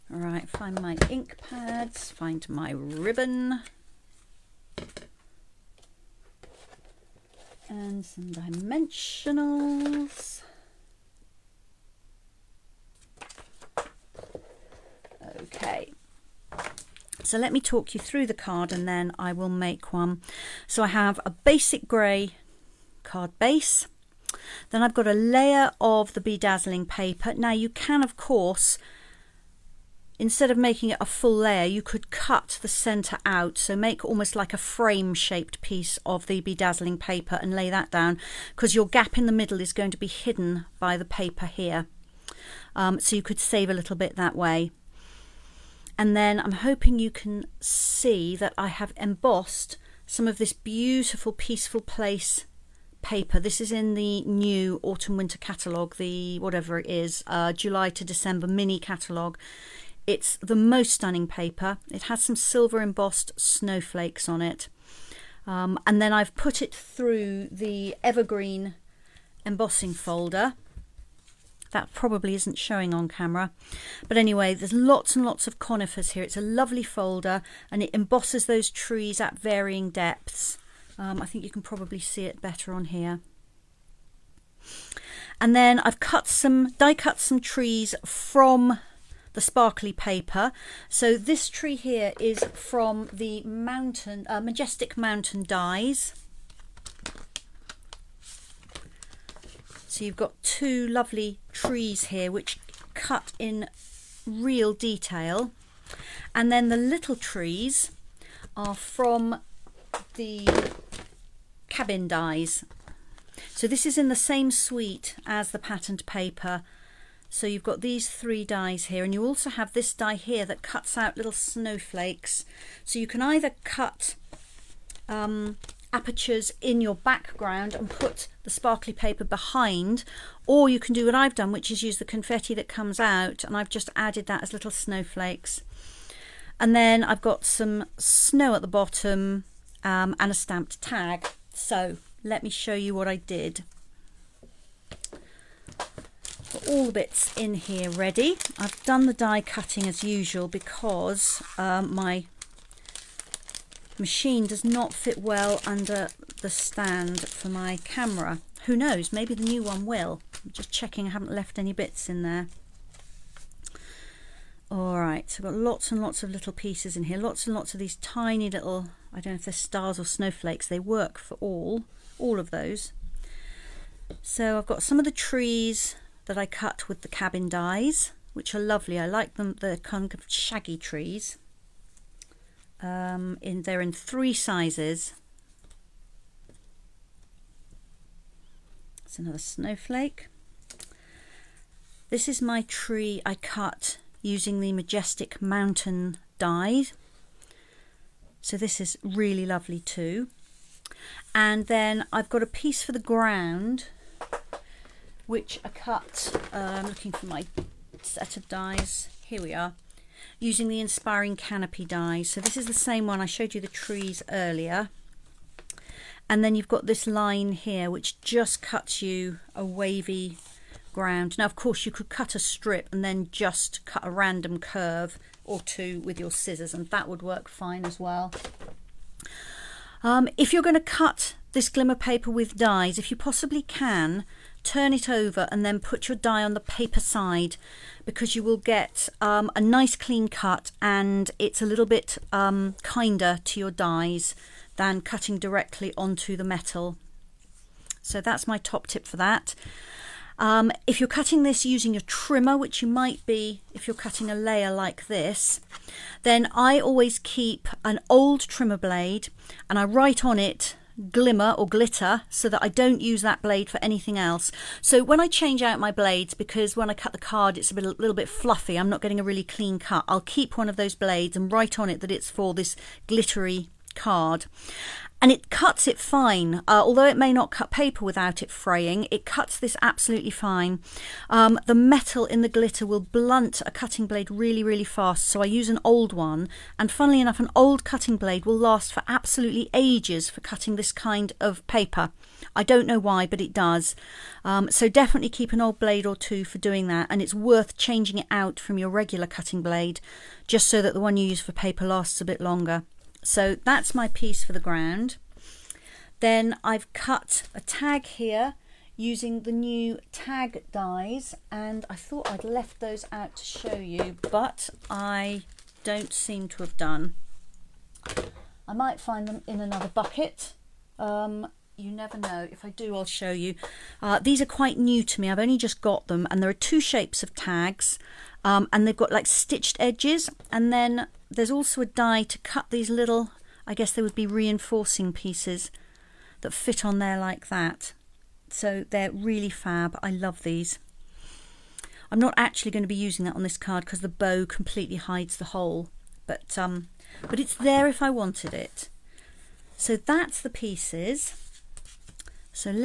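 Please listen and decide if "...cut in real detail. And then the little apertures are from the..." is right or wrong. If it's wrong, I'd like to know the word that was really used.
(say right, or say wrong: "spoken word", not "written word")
wrong: "trees", not "apertures".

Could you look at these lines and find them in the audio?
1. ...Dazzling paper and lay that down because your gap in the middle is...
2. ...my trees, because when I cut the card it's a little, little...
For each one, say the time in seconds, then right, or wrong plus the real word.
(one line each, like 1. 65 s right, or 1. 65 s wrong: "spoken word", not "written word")
1. 36 s right
2. 265 s wrong: "blades", not "trees".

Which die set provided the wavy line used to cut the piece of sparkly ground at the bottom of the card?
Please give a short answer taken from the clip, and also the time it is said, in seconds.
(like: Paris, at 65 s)
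Inspiring Canopy, at 210 s.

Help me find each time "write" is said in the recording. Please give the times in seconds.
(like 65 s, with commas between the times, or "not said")
259 s, 271 s.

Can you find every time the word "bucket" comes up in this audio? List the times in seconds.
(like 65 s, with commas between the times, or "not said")
319 s.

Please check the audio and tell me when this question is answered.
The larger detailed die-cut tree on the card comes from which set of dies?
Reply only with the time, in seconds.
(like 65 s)
94 s.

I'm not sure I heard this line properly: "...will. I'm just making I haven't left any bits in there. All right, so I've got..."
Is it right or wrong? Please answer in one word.
wrong.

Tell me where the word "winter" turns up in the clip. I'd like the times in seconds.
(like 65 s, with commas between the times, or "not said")
55 s.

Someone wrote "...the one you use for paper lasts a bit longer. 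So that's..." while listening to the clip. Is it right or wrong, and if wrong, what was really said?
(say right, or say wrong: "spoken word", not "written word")
right.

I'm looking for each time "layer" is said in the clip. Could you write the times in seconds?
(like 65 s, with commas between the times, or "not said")
25 s, 31 s, 254 s.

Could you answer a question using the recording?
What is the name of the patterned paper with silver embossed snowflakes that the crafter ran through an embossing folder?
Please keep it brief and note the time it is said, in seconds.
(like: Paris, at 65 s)
Peaceful Place, at 51 s.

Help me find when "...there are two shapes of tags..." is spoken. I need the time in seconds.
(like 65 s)
326 s.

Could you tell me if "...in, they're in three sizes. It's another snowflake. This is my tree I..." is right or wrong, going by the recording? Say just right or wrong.
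right.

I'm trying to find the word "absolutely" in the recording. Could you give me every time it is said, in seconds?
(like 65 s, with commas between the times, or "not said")
279 s, 289 s.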